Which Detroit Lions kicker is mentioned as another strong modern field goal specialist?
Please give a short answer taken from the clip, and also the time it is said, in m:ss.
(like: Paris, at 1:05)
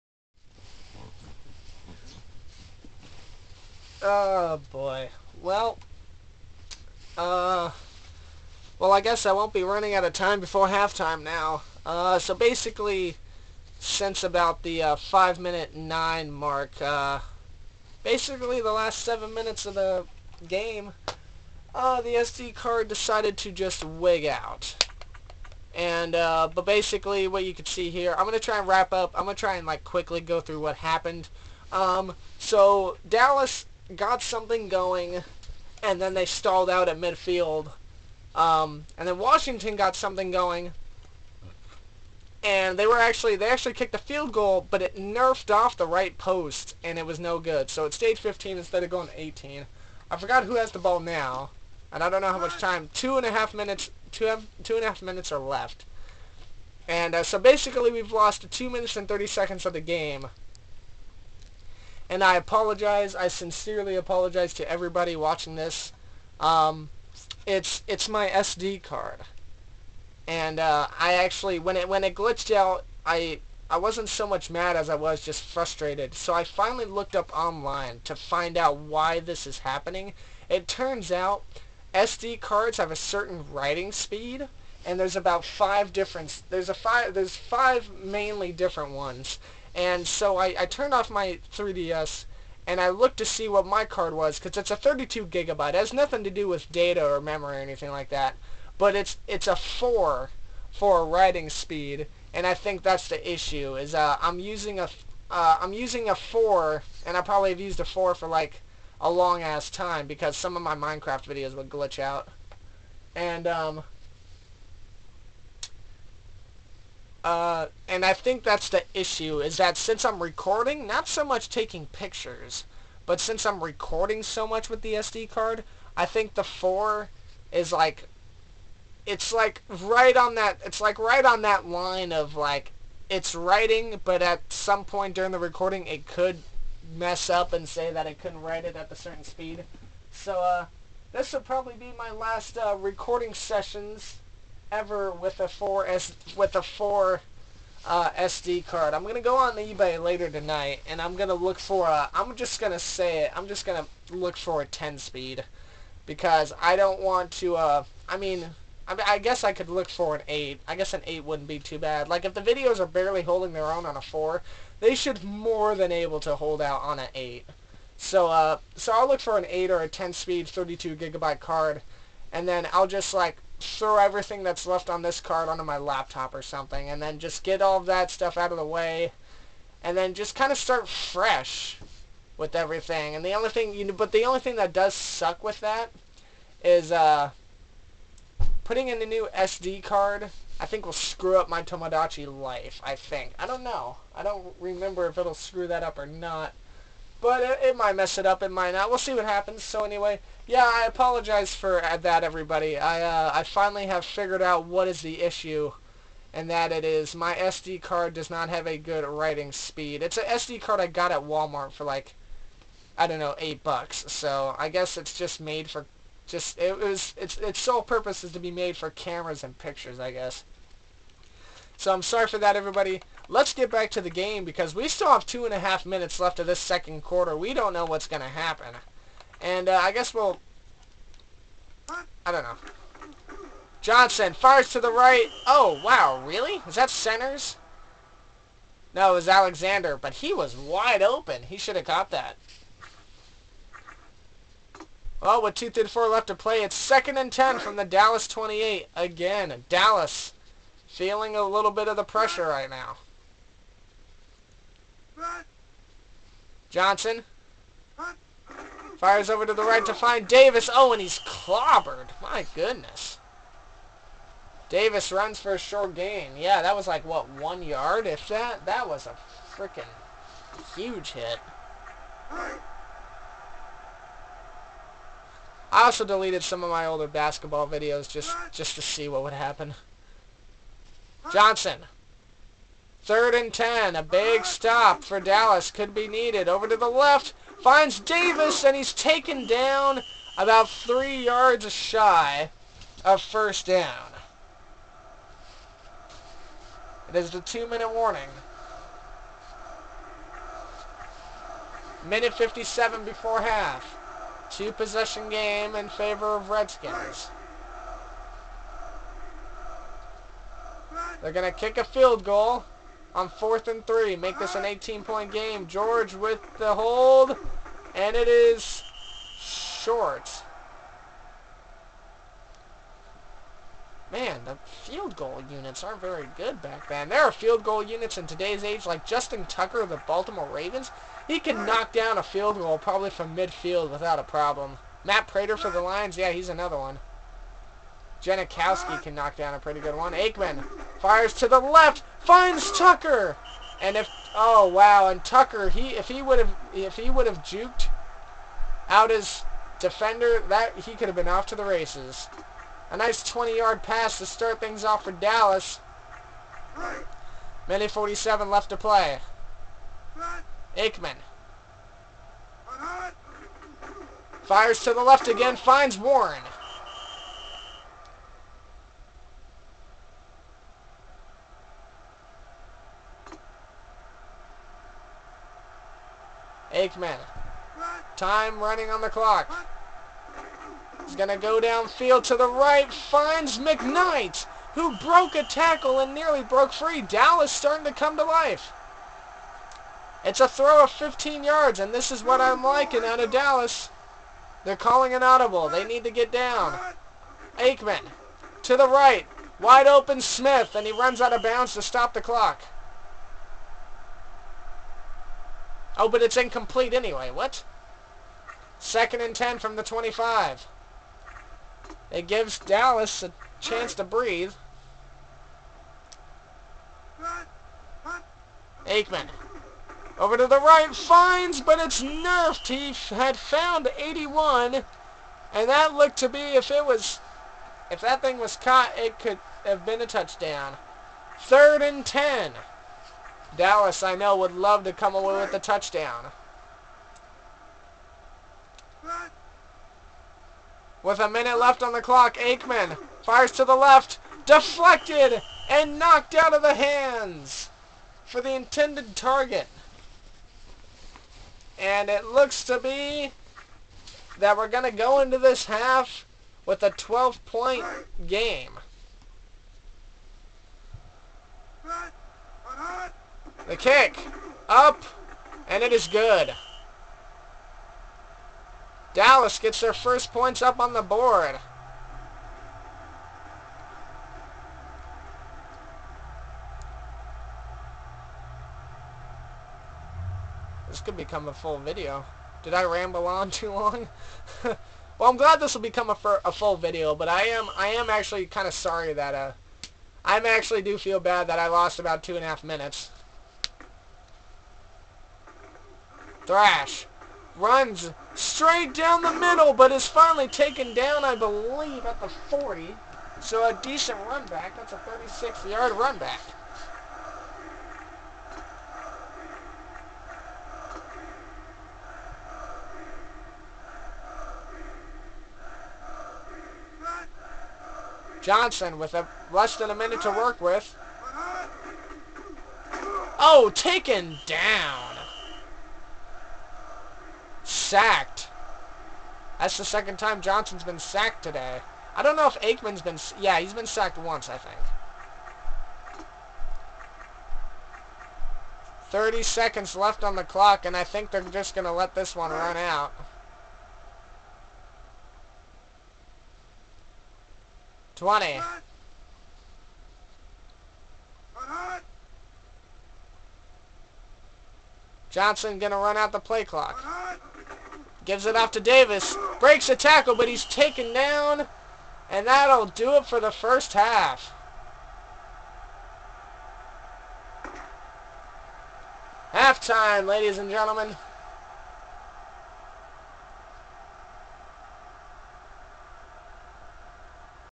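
Matt Prater, at 5:35.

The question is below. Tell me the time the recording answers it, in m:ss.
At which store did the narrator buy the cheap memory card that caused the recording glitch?
3:31.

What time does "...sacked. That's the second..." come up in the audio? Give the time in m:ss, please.
8:47.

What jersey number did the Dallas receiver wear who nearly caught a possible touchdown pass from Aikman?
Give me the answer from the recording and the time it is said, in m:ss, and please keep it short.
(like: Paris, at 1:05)
81, at 7:03.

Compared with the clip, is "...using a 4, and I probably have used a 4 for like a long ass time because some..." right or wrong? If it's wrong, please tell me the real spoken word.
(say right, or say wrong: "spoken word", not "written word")
right.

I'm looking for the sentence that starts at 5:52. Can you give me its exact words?
A nice 20-yard pass to start things off for Dallas.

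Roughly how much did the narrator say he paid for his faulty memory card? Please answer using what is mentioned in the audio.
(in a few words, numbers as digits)
8 bucks.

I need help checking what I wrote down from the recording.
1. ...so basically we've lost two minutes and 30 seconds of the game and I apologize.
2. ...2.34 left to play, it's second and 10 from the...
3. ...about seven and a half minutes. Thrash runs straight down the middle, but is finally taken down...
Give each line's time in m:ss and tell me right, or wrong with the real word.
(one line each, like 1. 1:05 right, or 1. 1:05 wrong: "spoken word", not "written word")
1. 0:57 right
2. 4:05 right
3. 8:11 wrong: "two", not "seven".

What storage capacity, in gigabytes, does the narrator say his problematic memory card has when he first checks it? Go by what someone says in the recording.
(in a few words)
32 gigabyte.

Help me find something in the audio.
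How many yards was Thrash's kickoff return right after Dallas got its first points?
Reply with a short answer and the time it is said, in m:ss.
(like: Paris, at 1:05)
36 yards, at 8:24.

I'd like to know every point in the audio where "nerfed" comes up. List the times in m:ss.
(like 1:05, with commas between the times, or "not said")
0:44, 7:02.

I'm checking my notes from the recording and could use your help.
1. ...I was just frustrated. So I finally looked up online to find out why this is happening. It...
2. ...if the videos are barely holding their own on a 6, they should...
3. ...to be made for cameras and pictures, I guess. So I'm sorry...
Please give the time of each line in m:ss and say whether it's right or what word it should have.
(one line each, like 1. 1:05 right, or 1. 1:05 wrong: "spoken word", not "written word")
1. 1:14 right
2. 2:42 wrong: "4", not "6"
3. 3:38 right.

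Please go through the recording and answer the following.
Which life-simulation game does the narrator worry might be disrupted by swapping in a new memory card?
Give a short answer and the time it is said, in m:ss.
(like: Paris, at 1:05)
Tomodachi Life, at 3:11.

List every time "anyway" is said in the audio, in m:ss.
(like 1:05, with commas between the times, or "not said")
3:19, 6:46.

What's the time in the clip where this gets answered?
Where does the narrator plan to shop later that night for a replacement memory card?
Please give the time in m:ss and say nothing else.
2:29.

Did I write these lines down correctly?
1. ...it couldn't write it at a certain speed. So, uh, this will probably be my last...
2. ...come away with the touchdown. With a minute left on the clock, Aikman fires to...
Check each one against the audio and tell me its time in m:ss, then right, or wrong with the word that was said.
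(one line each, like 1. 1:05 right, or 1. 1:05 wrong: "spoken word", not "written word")
1. 2:18 right
2. 7:14 right.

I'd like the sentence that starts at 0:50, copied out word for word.
I forgot who has the ball now, and I don't know how much time.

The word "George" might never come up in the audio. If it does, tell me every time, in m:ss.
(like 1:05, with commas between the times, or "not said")
5:15.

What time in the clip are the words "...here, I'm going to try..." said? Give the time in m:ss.
0:27.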